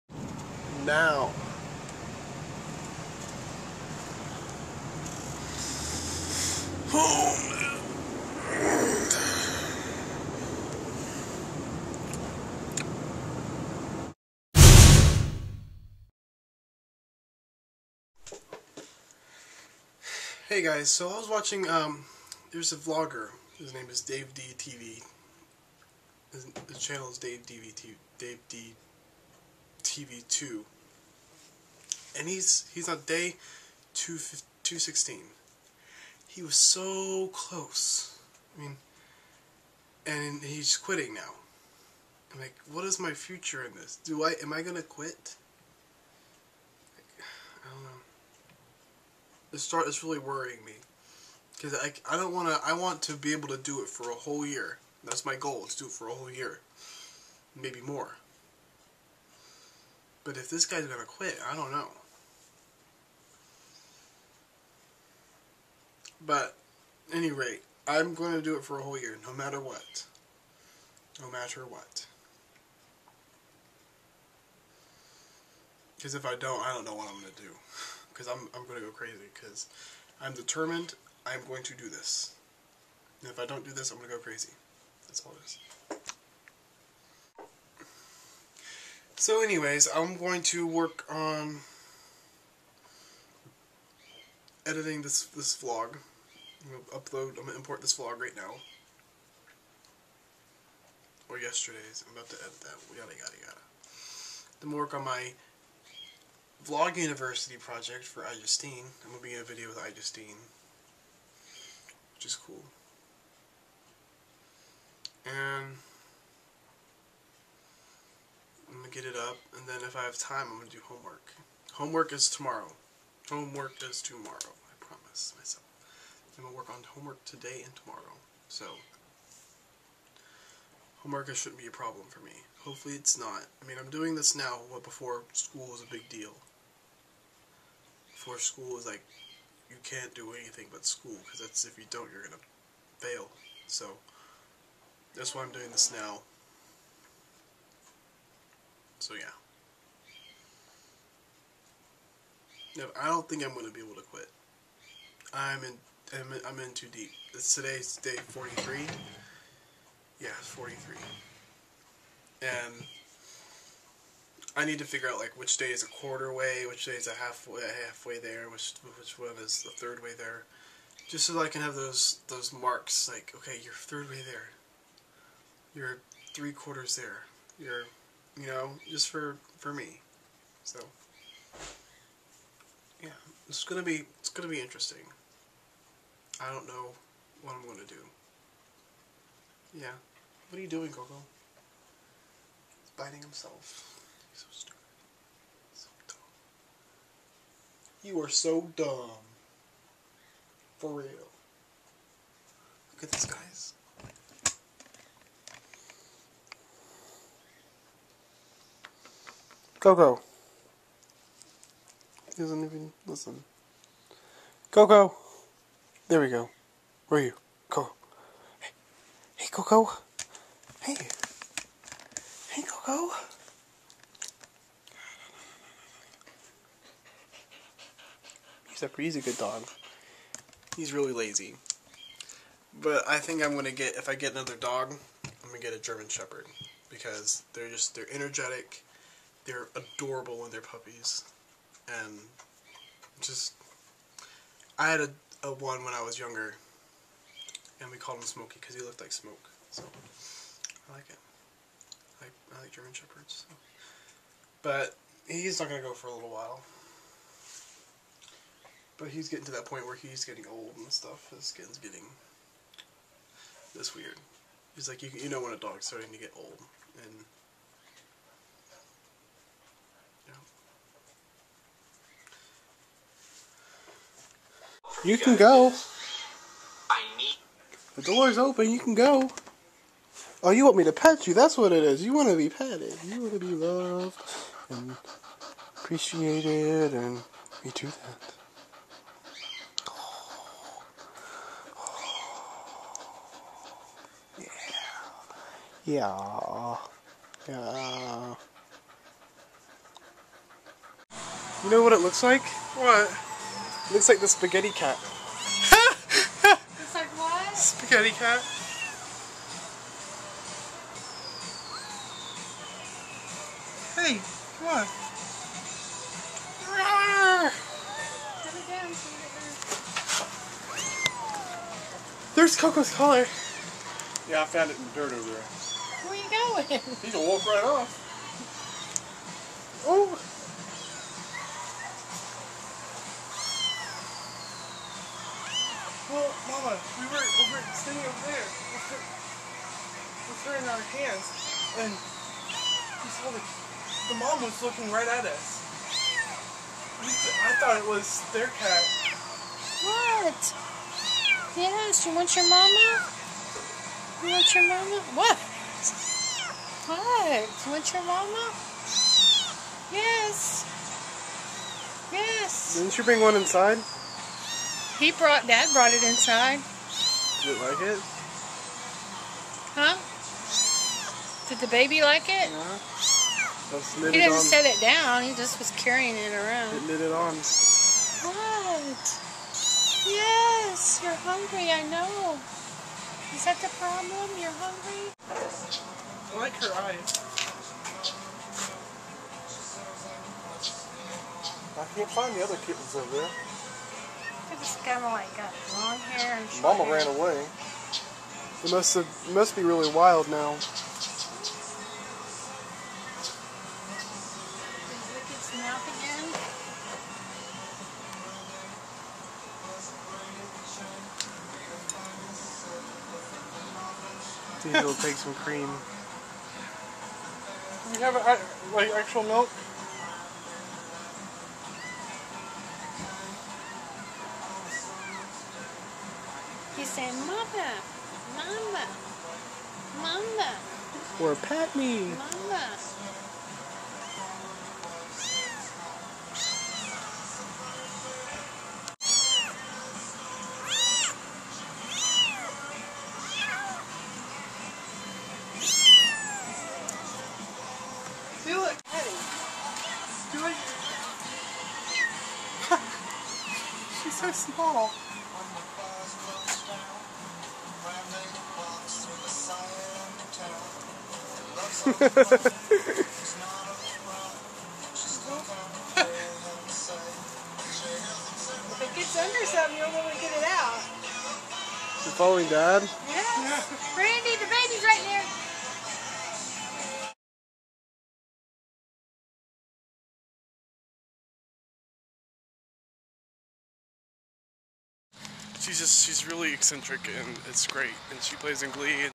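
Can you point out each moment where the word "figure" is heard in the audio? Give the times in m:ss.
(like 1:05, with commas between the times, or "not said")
2:44.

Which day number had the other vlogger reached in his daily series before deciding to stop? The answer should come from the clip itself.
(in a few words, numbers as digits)
216.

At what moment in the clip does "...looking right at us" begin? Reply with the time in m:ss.
5:44.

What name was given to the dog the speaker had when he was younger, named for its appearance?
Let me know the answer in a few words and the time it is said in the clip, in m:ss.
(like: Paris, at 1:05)
Smokey, at 4:08.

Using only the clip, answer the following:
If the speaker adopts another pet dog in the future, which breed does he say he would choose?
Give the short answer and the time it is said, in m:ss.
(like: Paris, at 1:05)
German Shepherd, at 3:55.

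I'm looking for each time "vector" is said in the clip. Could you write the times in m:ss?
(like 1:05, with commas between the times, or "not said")
not said.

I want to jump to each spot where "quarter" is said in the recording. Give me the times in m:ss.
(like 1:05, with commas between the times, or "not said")
2:45, 2:56.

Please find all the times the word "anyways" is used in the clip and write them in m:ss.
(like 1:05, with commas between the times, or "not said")
1:29.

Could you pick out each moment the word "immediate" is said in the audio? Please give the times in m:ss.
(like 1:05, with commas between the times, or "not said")
not said.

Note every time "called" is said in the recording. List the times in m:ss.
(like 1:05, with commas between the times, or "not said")
4:07.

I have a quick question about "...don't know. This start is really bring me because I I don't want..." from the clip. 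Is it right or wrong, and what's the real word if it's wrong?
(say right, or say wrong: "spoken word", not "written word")
wrong: "worrying", not "bring".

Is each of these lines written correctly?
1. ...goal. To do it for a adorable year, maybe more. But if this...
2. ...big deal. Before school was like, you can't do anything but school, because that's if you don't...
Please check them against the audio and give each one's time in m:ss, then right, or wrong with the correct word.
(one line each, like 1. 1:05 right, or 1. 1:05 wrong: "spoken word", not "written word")
1. 0:55 wrong: "whole", not "adorable"
2. 2:15 right.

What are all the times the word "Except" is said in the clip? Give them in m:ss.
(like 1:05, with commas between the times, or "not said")
3:48.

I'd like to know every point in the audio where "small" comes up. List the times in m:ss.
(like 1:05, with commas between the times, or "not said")
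7:34.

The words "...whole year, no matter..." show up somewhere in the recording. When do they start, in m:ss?
1:08.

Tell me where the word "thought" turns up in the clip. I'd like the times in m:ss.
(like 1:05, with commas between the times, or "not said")
5:47.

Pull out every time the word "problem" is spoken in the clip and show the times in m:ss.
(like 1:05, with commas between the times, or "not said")
2:11, 6:23.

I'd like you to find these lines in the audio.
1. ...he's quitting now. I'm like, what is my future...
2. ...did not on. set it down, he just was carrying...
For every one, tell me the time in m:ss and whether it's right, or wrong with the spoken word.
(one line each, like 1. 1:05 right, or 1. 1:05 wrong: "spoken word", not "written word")
1. 0:40 right
2. 6:14 right.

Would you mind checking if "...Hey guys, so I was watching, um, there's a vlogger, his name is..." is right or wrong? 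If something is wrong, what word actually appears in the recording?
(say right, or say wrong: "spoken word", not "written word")
right.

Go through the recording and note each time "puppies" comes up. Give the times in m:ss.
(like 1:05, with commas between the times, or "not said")
4:00.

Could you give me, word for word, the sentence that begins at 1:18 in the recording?
Because I'm, I'm going to go crazy.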